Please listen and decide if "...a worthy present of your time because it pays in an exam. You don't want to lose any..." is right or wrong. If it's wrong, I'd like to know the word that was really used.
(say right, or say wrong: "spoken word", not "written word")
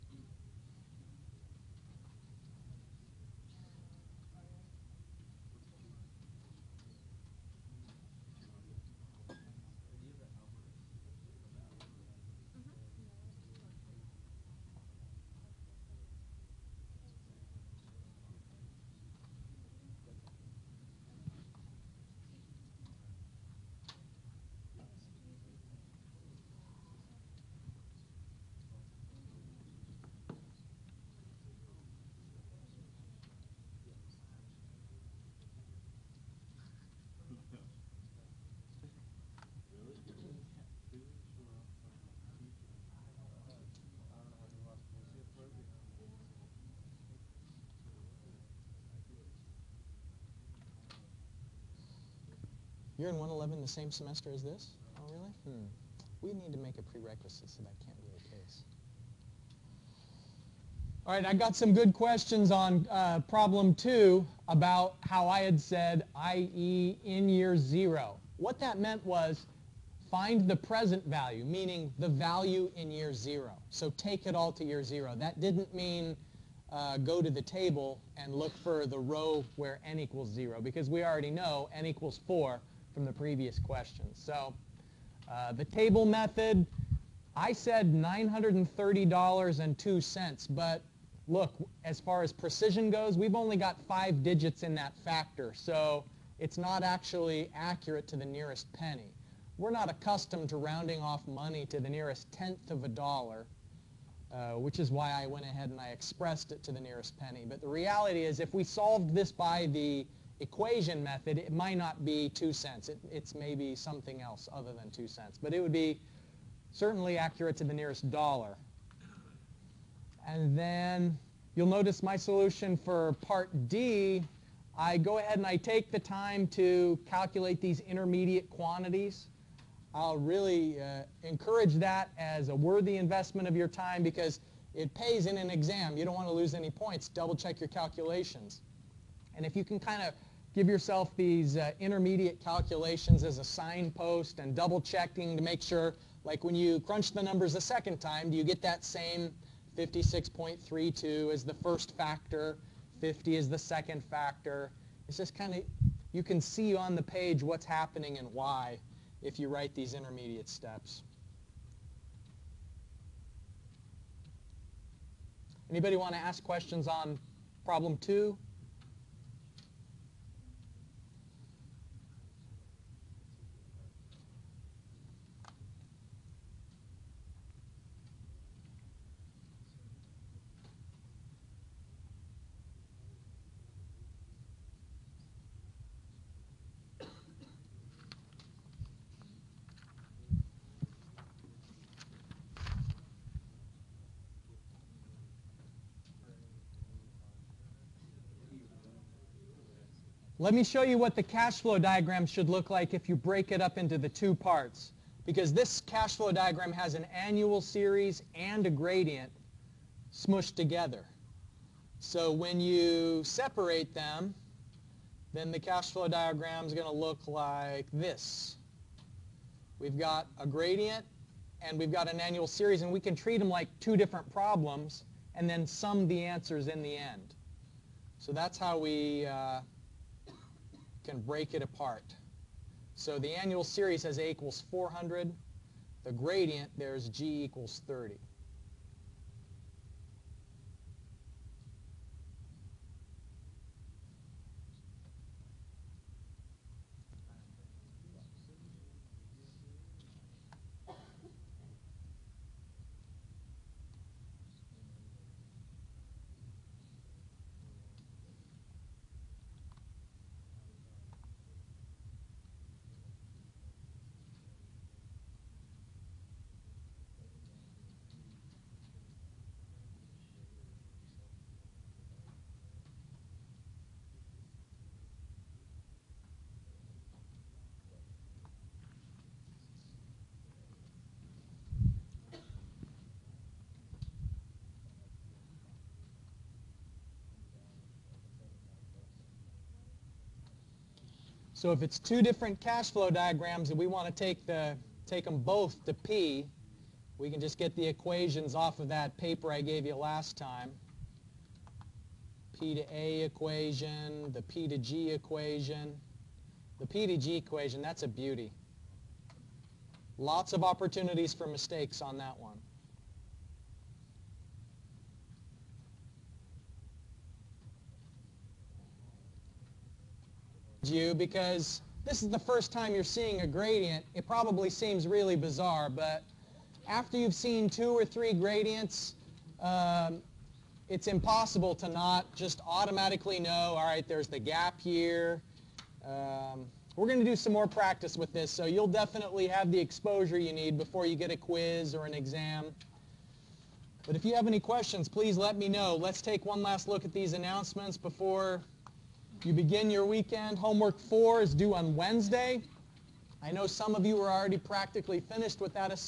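wrong: "investment", not "present".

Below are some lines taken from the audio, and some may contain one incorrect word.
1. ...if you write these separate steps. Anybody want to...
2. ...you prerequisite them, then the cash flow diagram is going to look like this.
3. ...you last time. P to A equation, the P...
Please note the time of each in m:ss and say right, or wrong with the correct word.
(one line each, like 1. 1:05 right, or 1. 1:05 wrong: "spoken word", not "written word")
1. 2:39 wrong: "intermediate", not "separate"
2. 3:32 wrong: "separate", not "prerequisite"
3. 4:59 right.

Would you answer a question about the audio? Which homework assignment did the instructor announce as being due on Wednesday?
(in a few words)
Homework 4.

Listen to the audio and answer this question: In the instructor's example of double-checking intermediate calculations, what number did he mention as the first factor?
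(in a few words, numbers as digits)
56.32.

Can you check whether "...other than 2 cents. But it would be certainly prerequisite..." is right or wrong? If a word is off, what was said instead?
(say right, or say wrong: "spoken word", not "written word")
wrong: "accurate", not "prerequisite".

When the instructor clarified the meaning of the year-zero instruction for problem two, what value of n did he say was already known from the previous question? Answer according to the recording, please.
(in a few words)
4.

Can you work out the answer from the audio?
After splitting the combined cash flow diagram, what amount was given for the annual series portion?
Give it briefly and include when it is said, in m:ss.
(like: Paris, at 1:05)
400, at 3:54.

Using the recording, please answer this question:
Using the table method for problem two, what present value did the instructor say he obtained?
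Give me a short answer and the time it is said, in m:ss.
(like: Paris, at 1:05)
$930.02, at 1:27.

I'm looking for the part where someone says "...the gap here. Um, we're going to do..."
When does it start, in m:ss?
5:34.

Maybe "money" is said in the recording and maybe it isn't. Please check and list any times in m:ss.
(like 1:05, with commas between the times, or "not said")
1:41.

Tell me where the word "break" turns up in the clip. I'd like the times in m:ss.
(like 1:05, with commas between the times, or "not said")
3:23, 3:51.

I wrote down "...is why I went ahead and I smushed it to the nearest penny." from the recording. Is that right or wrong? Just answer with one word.
wrong.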